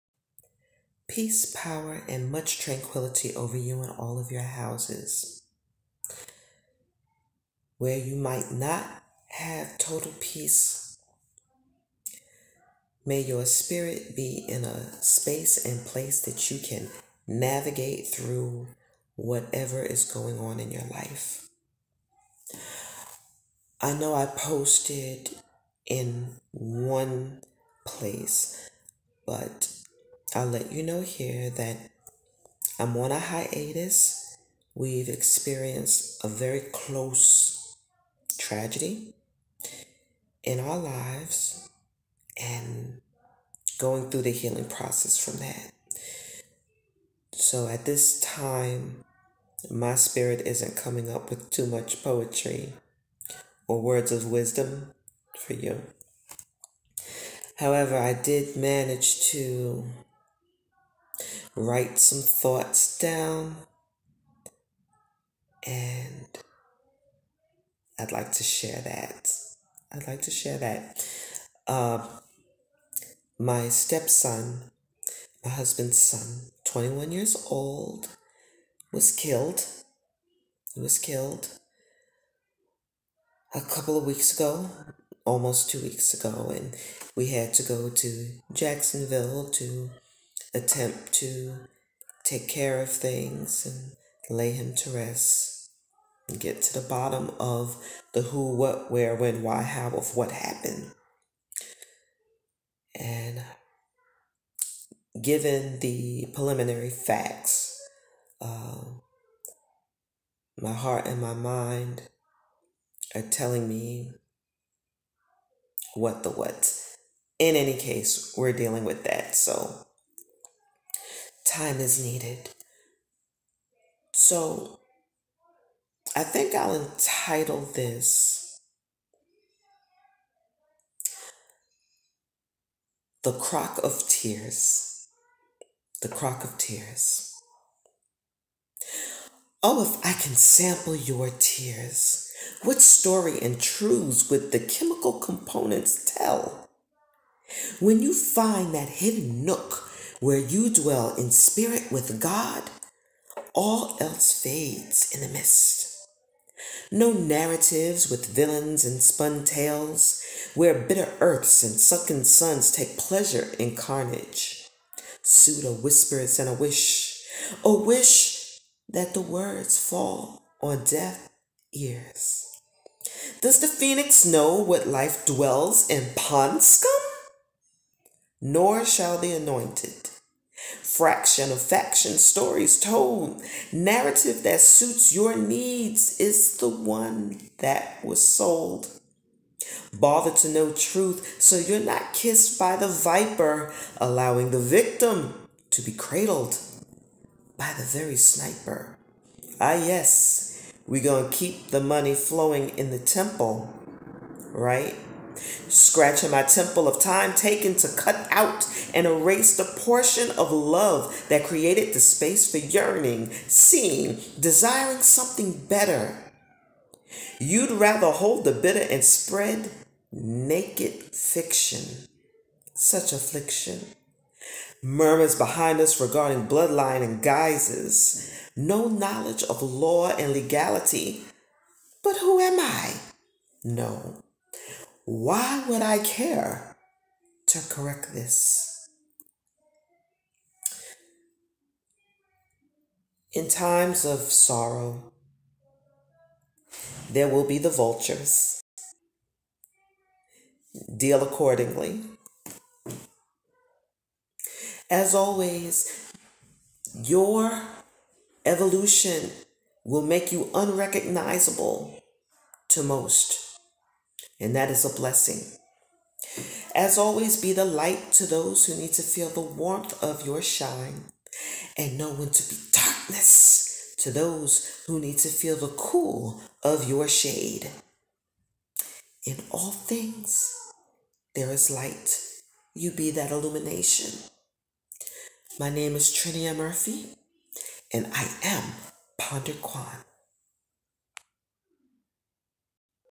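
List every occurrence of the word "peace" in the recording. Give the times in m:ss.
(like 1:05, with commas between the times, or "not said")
0:01, 0:10.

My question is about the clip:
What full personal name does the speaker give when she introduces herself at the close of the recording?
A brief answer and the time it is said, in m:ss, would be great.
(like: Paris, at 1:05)
Trinia Murphy, at 4:46.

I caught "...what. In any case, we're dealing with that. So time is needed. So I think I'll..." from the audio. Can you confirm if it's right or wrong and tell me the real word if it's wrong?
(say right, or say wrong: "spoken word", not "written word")
right.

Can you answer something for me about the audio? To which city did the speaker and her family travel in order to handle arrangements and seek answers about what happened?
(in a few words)
Jacksonville.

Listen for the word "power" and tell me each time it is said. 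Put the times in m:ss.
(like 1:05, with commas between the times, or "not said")
0:01.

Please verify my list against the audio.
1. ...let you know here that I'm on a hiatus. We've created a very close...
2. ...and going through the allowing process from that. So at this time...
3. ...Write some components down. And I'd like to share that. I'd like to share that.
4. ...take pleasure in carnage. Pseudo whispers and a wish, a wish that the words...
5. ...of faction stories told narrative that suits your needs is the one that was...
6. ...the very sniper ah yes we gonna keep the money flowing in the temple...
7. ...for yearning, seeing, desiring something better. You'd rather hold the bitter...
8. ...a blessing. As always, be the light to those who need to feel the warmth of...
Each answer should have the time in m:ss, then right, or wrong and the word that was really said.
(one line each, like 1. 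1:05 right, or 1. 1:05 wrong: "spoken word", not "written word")
1. 0:30 wrong: "experienced", not "created"
2. 0:42 wrong: "healing", not "allowing"
3. 1:01 wrong: "thoughts", not "components"
4. 2:42 right
5. 3:01 right
6. 3:17 right
7. 3:32 right
8. 4:24 right.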